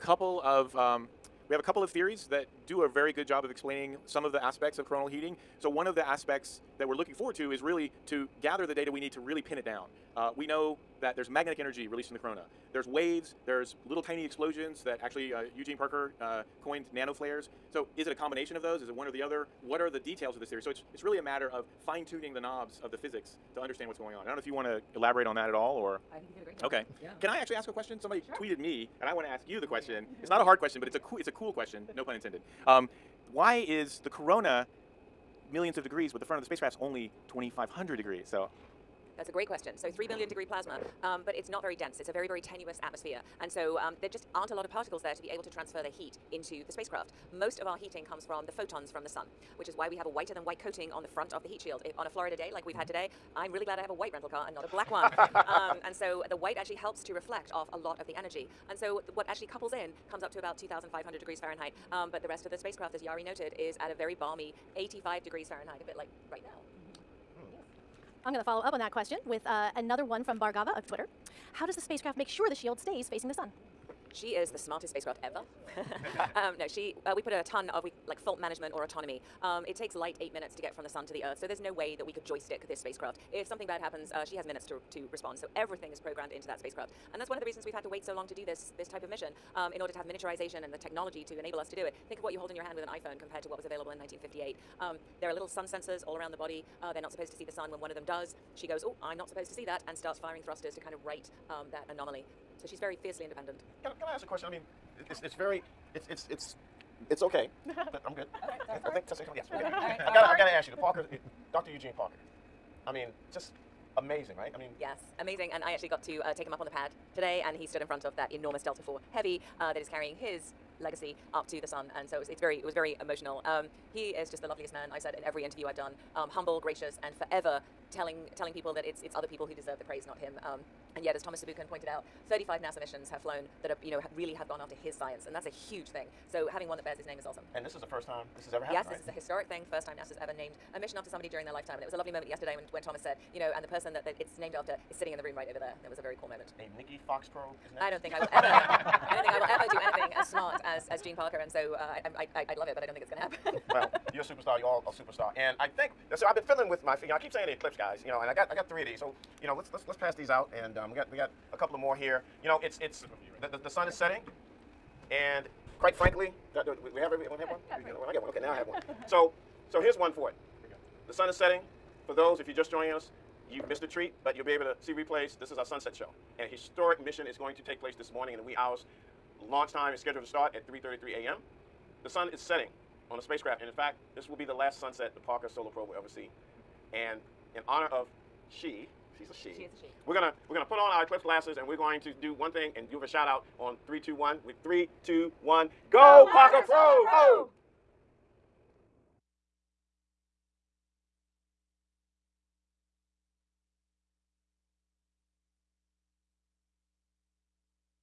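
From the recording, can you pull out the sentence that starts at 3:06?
And in honor of she, she's a she.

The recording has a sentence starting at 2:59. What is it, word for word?
Launch time is scheduled to start at 3.33 a.m.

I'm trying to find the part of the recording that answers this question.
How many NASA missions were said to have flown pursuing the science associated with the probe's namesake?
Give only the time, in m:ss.
2:12.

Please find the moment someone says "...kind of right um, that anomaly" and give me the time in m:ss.
1:40.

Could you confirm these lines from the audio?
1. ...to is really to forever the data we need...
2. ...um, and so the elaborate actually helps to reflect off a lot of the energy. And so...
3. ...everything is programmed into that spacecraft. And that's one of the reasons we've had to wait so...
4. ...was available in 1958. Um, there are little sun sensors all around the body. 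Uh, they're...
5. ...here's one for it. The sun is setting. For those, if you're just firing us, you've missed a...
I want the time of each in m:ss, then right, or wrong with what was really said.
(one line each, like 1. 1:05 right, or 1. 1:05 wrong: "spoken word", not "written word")
1. 0:07 wrong: "gather", not "forever"
2. 0:55 wrong: "white", not "elaborate"
3. 1:25 right
4. 1:33 right
5. 2:49 wrong: "joining", not "firing".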